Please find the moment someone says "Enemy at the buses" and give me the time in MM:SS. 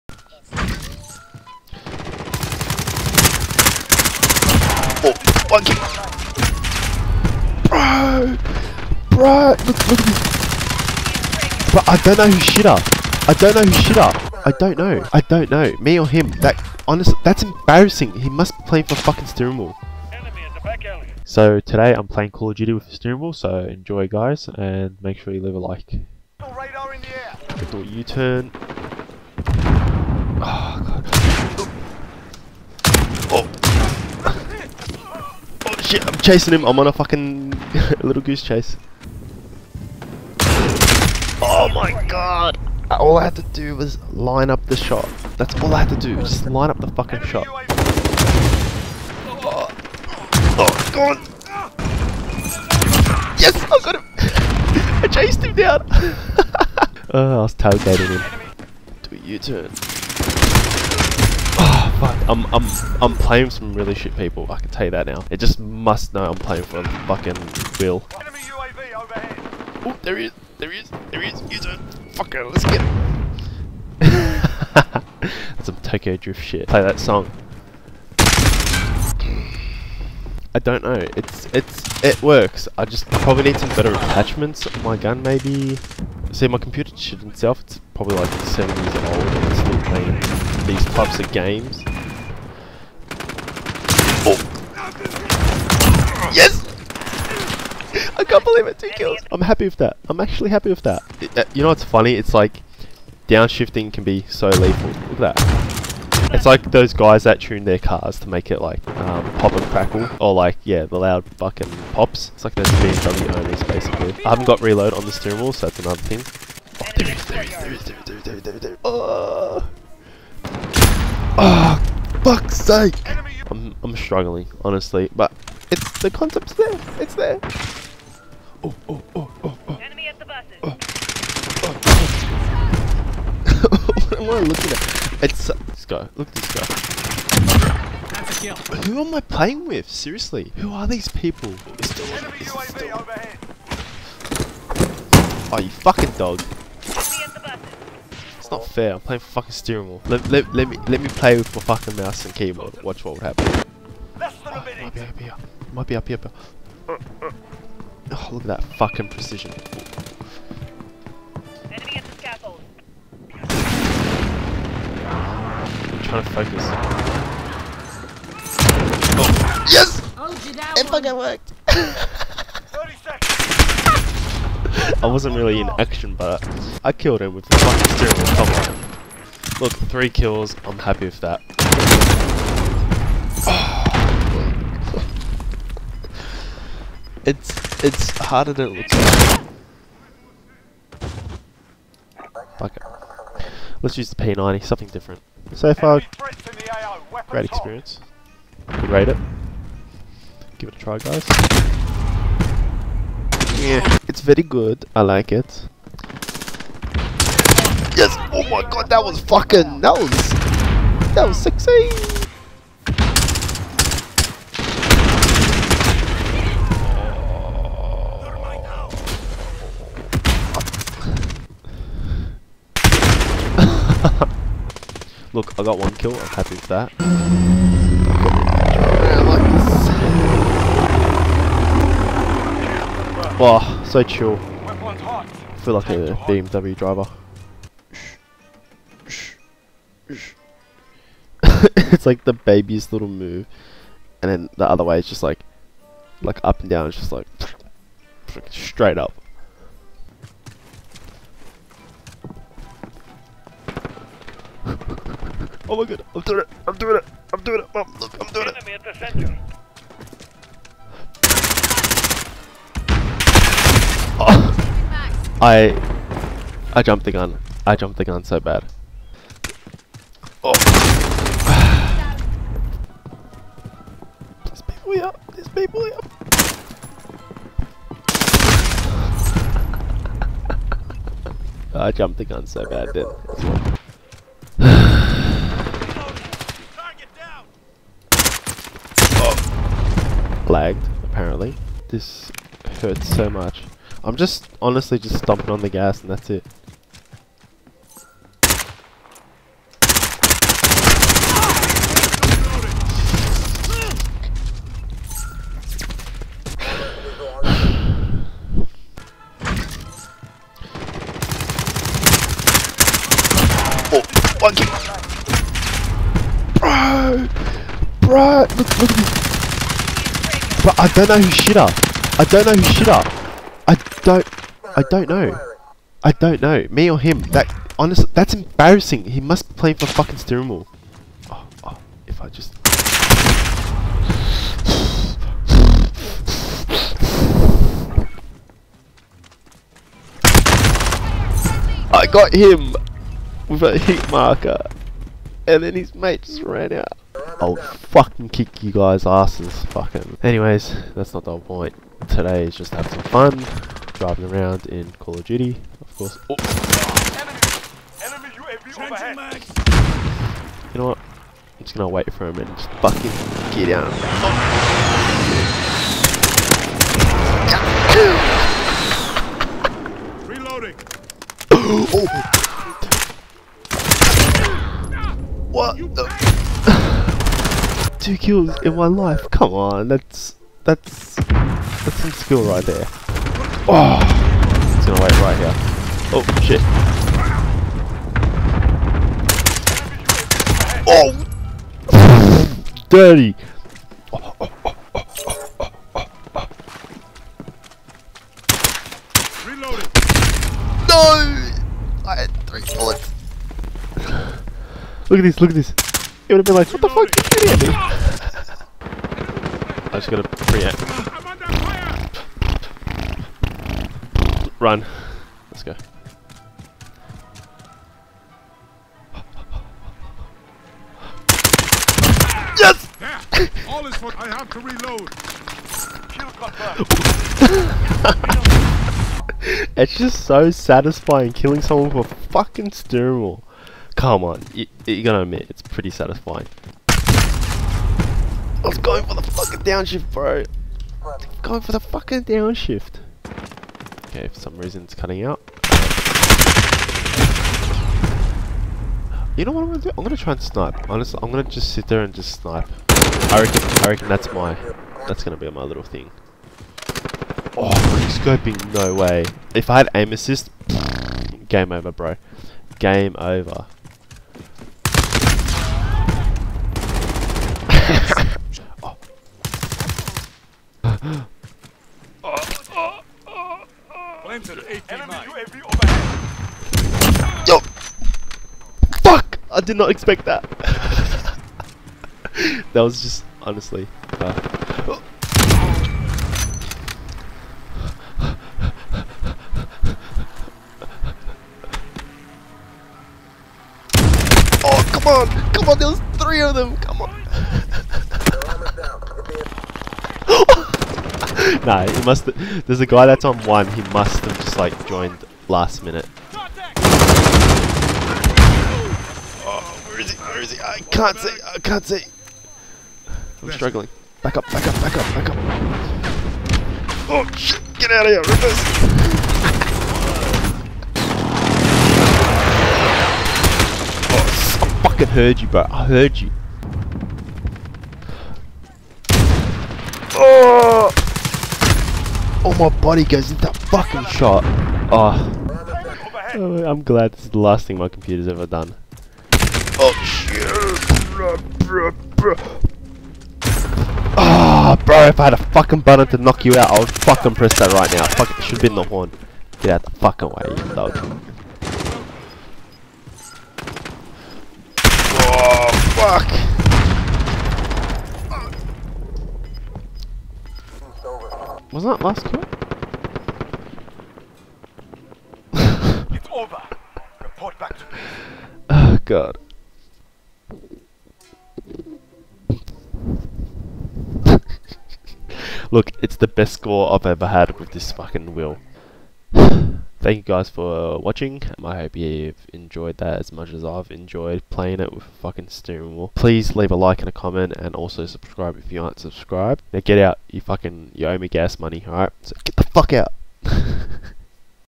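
02:09.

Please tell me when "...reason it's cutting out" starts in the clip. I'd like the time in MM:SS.
07:24.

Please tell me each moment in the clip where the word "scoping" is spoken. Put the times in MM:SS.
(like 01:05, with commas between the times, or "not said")
07:38.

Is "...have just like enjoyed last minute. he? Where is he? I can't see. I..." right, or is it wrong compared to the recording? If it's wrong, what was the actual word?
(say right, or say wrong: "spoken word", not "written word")
wrong: "joined", not "enjoyed".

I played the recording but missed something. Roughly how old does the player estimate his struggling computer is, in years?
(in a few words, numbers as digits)
7.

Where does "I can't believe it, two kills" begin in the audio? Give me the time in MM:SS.
01:38.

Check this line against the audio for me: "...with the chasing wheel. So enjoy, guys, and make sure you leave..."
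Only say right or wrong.
wrong.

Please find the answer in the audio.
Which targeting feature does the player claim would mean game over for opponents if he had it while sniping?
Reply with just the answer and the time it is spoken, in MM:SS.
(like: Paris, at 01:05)
aim assist, at 07:39.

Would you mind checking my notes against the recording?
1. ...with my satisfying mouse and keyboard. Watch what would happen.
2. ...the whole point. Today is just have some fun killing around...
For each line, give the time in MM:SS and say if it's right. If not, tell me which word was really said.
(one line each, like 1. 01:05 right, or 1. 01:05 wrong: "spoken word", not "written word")
1. 02:31 wrong: "fucking", not "satisfying"
2. 05:51 wrong: "driving", not "killing".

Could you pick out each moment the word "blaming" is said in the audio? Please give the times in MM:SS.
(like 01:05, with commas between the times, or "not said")
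not said.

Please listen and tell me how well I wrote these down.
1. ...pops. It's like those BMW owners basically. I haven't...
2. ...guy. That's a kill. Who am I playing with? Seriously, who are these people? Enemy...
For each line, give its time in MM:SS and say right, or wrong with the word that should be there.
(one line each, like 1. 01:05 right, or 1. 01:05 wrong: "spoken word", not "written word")
1. 01:51 right
2. 02:16 right.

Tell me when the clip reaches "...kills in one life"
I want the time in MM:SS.
06:18.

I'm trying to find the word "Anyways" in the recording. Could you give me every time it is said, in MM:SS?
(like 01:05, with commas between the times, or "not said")
05:50.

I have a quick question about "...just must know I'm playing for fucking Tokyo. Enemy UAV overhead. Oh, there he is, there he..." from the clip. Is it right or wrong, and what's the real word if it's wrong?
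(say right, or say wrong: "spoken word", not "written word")
wrong: "Will", not "Tokyo".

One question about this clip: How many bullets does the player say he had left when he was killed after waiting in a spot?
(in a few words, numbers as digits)
3.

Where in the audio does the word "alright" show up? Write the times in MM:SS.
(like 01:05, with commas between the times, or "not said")
09:51.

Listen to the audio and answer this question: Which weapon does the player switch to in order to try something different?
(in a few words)
P90.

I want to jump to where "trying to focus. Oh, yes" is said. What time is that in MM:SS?
02:46.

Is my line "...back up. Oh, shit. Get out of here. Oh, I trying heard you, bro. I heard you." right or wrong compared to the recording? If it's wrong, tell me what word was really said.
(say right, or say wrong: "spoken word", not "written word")
wrong: "fucking", not "trying".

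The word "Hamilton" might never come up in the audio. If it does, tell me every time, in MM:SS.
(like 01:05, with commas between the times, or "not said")
not said.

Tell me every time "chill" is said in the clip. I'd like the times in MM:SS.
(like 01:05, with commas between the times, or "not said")
03:54.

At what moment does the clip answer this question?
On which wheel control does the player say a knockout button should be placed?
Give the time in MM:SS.
09:08.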